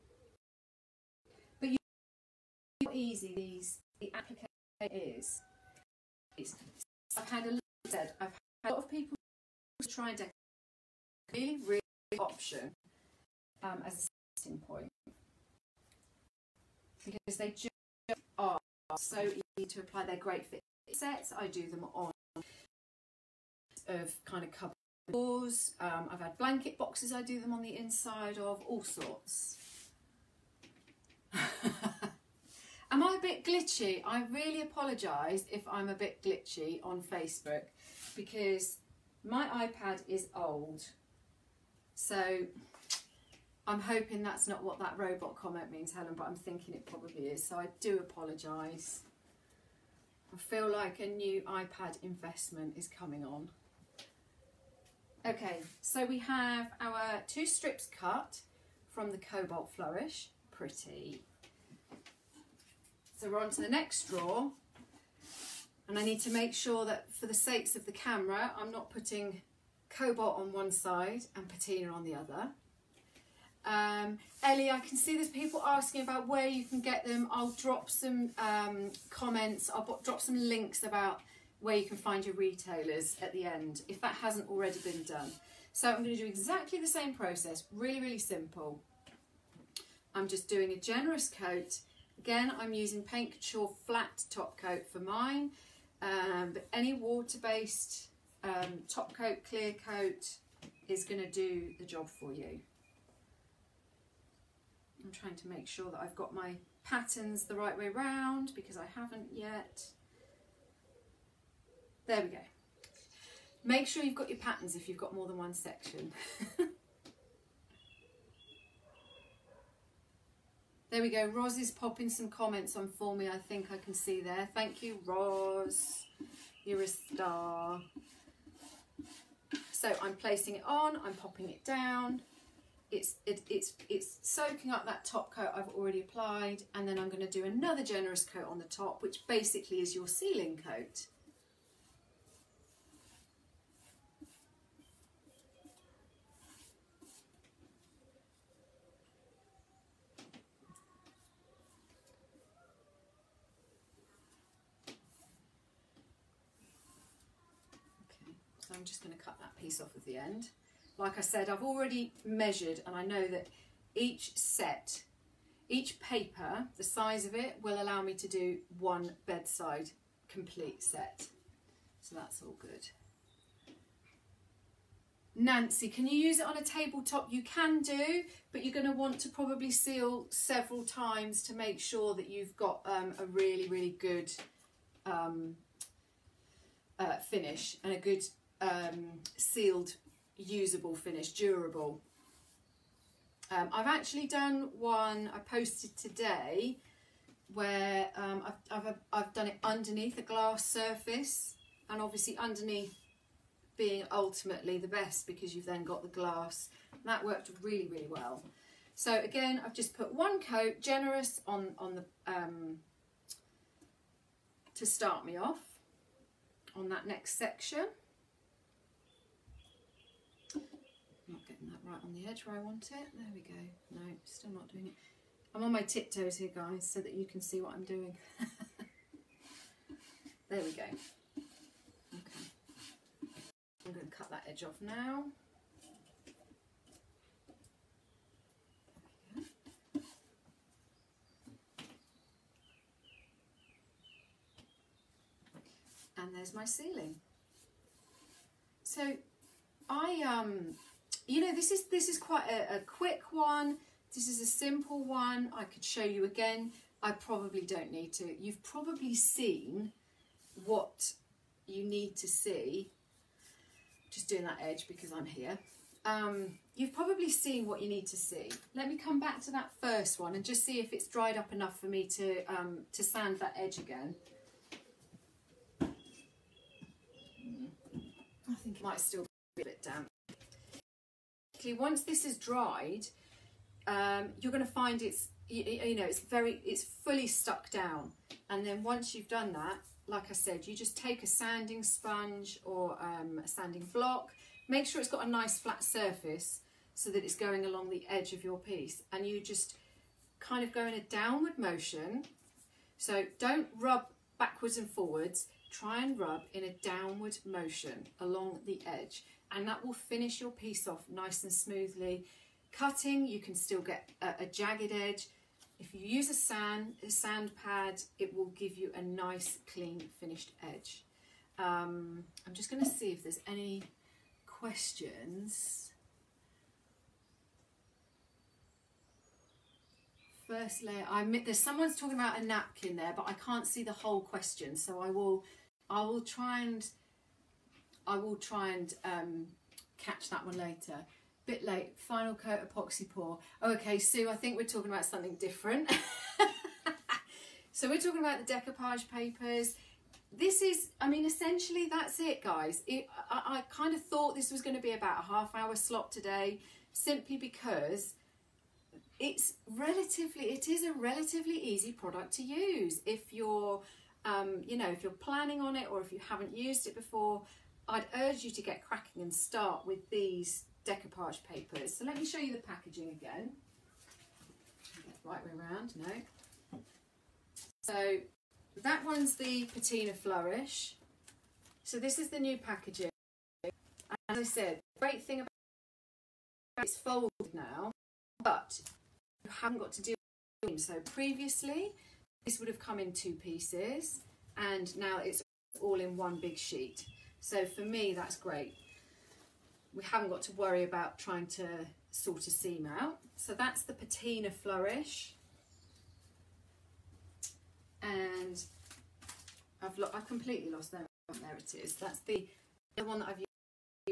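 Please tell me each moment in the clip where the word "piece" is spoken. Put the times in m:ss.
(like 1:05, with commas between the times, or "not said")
2:39, 4:58, 5:10, 6:33.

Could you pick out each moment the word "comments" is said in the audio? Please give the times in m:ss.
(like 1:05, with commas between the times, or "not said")
0:45, 1:19, 2:02.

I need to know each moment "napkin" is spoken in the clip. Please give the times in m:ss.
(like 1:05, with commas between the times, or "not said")
5:32.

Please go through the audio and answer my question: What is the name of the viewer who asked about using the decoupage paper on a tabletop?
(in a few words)
Nancy.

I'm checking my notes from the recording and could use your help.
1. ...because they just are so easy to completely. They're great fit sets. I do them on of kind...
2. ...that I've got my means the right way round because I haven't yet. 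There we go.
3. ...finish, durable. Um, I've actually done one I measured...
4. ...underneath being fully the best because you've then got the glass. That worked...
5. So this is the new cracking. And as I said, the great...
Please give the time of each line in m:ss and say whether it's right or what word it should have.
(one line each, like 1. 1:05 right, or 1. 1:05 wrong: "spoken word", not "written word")
1. 0:17 wrong: "apply", not "completely"
2. 1:45 wrong: "patterns", not "means"
3. 3:10 wrong: "posted", not "measured"
4. 3:22 wrong: "ultimately", not "fully"
5. 6:21 wrong: "packaging", not "cracking".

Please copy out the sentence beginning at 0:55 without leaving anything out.
Okay, so we have our two strips cut from the Cobalt Flourish.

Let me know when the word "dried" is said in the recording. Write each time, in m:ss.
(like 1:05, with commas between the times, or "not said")
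4:31, 4:42.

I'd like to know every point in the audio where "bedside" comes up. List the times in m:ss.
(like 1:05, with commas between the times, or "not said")
2:49.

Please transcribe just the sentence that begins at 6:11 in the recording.
So let me show you the packaging again.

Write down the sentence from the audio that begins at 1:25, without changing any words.
So I'm going to do exactly the same process, really, really simple.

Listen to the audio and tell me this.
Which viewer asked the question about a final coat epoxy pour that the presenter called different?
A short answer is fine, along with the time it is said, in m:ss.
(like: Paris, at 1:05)
Sue, at 5:43.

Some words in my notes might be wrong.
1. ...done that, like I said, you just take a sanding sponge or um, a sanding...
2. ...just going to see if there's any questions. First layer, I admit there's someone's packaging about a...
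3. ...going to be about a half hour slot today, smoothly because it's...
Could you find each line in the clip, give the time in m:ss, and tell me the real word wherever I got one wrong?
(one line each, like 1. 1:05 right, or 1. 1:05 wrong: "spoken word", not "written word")
1. 4:49 right
2. 5:22 wrong: "talking", not "packaging"
3. 5:54 wrong: "simply", not "smoothly".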